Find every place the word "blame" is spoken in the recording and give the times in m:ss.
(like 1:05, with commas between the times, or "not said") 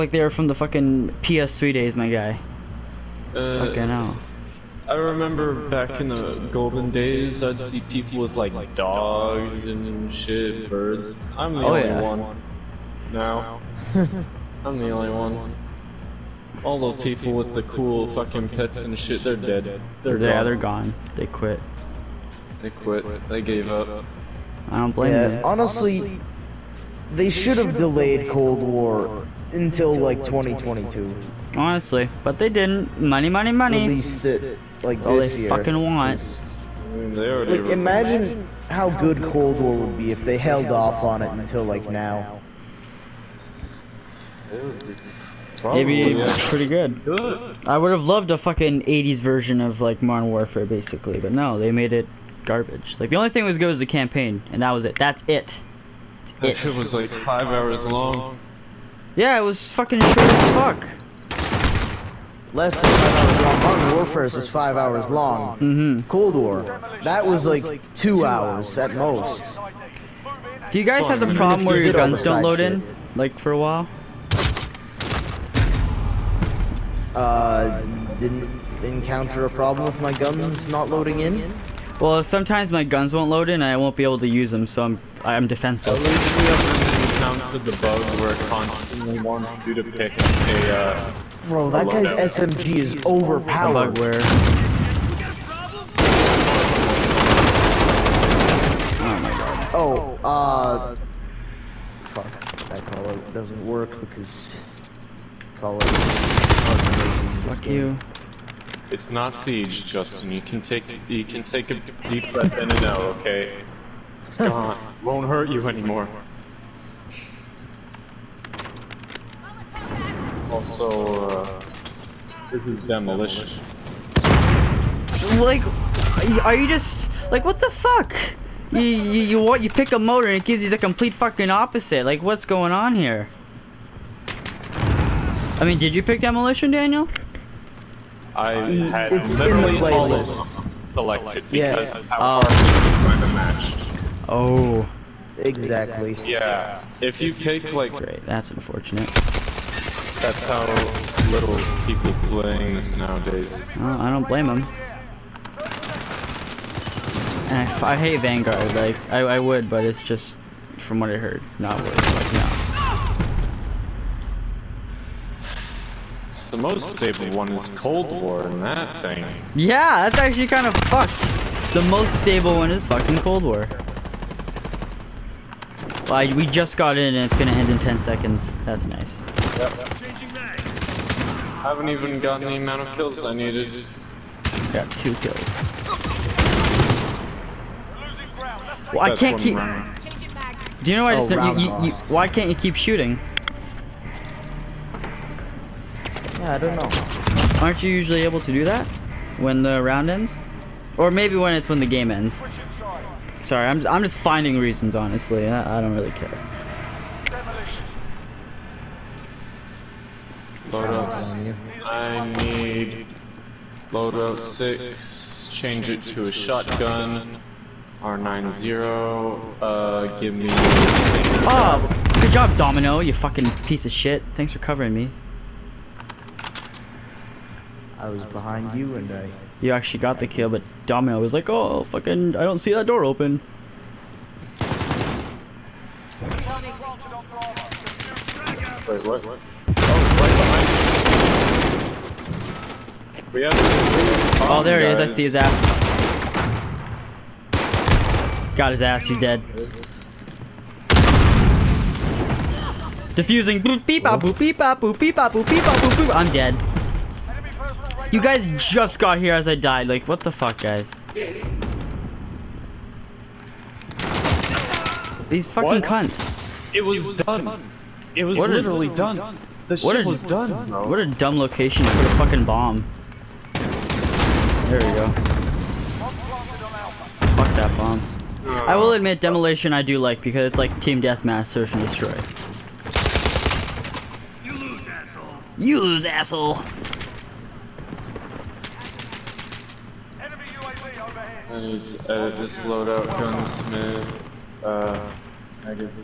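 0:24, 2:34.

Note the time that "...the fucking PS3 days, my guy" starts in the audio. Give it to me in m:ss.
0:00.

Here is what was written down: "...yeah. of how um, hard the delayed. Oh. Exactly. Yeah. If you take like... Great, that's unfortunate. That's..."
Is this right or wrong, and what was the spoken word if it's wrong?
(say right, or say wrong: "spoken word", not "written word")
wrong: "matched", not "delayed".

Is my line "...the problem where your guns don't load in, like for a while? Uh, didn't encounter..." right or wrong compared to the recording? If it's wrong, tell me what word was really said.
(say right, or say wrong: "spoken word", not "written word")
right.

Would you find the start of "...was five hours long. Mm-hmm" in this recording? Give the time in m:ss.
1:04.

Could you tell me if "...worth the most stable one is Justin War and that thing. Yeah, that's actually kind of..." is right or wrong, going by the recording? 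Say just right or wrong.
wrong.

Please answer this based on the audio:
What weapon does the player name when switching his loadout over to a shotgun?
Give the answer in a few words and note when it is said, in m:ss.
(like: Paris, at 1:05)
R90, at 3:37.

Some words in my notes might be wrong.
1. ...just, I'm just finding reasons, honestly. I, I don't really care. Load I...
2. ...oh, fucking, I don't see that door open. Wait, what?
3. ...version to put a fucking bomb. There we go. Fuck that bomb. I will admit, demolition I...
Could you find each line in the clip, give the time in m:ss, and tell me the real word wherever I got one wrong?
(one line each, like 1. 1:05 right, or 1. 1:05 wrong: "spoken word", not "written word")
1. 3:23 right
2. 3:51 right
3. 4:31 wrong: "location", not "version".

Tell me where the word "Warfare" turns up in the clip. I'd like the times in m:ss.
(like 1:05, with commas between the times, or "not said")
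0:50, 1:03.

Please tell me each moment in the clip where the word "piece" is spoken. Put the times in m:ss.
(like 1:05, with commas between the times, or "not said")
3:43.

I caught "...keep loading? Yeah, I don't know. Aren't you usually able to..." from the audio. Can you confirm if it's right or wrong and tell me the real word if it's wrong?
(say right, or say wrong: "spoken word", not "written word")
wrong: "shooting", not "loading".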